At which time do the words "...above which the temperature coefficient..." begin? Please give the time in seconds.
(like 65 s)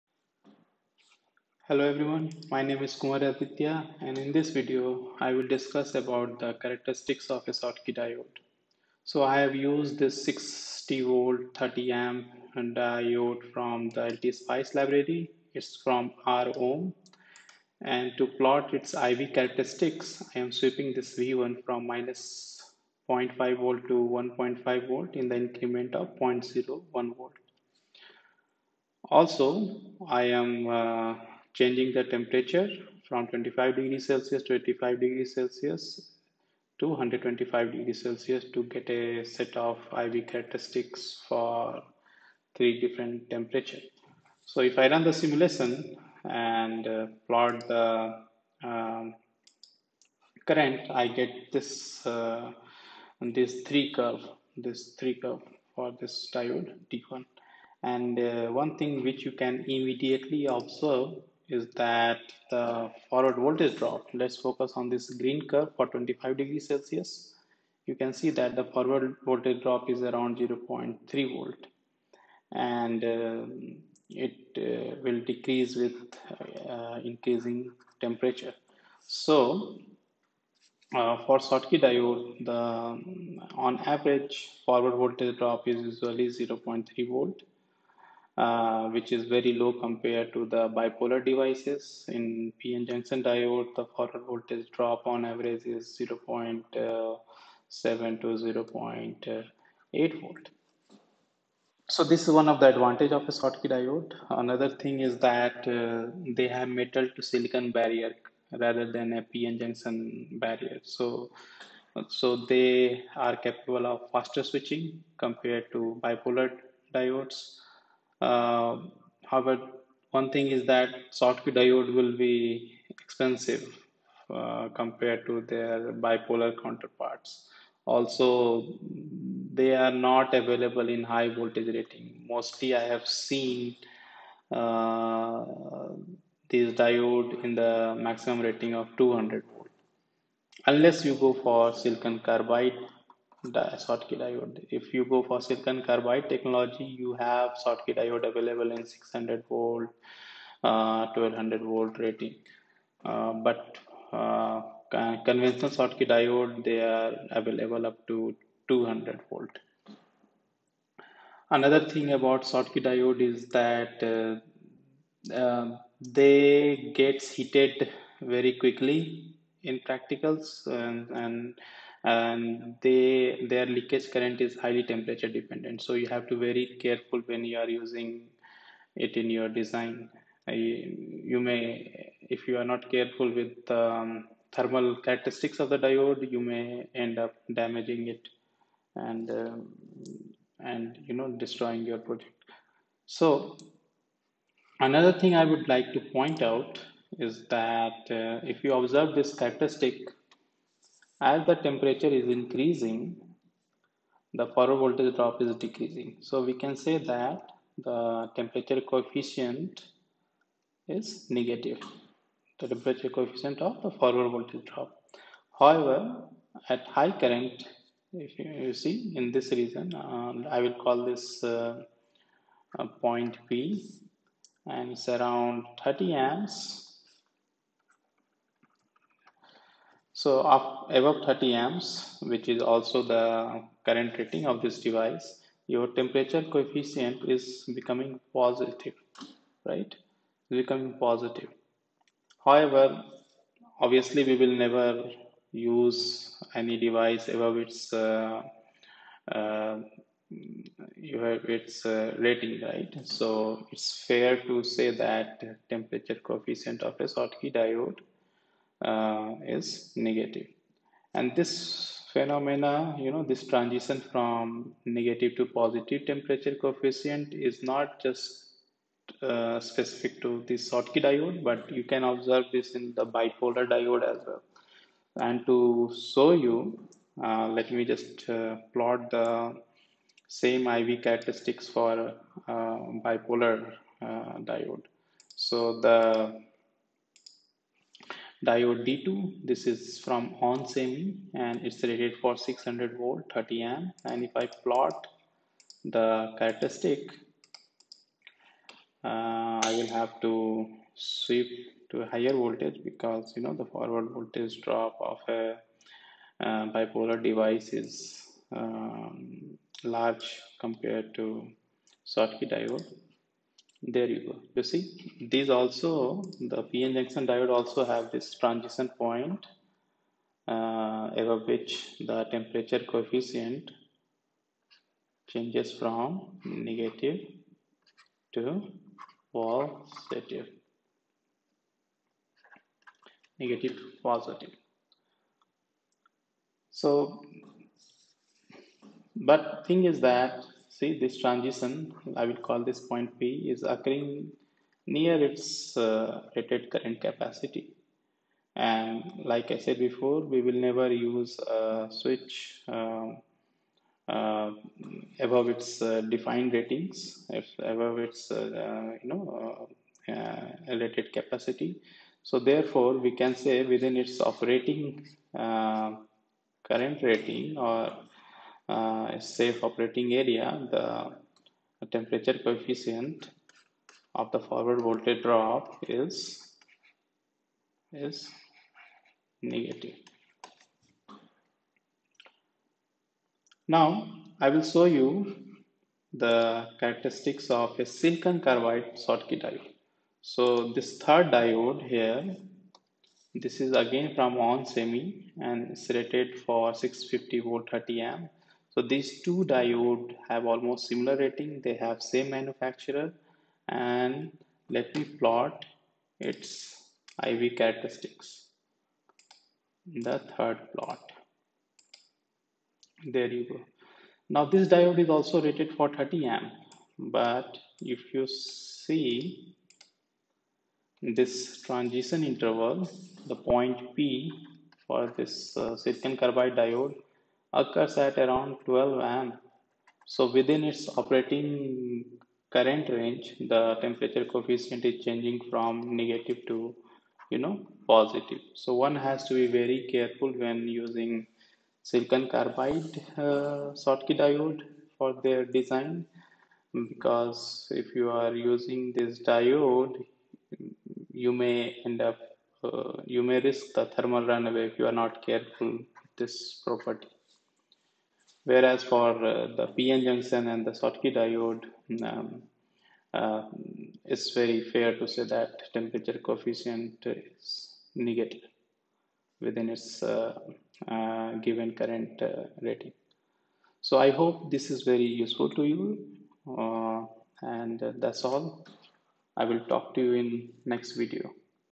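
321 s.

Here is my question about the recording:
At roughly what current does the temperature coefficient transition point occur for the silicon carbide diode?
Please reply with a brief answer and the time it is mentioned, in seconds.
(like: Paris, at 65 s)
12 amps, at 428 s.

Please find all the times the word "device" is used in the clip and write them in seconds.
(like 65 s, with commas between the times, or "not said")
91 s, 234 s, 246 s, 307 s.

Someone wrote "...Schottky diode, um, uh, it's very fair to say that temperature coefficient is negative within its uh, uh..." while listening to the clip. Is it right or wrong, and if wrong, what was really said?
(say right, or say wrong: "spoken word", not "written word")
right.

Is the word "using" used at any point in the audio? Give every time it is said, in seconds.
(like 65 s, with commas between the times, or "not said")
177 s, 440 s, 448 s.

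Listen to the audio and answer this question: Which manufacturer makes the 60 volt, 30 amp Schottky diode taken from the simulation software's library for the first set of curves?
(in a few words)
ROHM.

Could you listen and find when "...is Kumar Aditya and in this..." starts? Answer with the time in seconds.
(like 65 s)
2 s.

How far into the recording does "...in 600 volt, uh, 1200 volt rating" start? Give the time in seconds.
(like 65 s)
148 s.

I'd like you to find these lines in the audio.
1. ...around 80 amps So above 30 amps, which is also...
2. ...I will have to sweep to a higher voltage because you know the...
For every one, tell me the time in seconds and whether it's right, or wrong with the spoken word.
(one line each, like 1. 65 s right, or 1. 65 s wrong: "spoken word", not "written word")
1. 225 s wrong: "30", not "80"
2. 299 s right.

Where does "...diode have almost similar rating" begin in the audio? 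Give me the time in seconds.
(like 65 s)
399 s.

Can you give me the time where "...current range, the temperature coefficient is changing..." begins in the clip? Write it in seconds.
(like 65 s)
432 s.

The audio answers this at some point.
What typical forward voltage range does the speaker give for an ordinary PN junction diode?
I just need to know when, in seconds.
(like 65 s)
96 s.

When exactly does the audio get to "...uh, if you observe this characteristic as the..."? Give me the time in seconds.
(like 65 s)
198 s.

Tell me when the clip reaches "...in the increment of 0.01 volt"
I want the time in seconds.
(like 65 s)
25 s.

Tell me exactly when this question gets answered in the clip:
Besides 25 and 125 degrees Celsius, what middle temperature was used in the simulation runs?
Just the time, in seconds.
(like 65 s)
34 s.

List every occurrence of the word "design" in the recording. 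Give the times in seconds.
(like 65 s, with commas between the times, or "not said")
179 s, 445 s.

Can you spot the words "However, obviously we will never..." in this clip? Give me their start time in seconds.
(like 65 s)
242 s.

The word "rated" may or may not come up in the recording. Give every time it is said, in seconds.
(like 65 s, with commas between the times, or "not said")
291 s, 346 s, 360 s, 395 s, 415 s.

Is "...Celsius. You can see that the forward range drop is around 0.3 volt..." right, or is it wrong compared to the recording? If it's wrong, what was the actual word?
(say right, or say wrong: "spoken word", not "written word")
wrong: "voltage", not "range".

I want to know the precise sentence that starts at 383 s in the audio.
Now I will show you the characteristics of a silicon carbide Schottky diode.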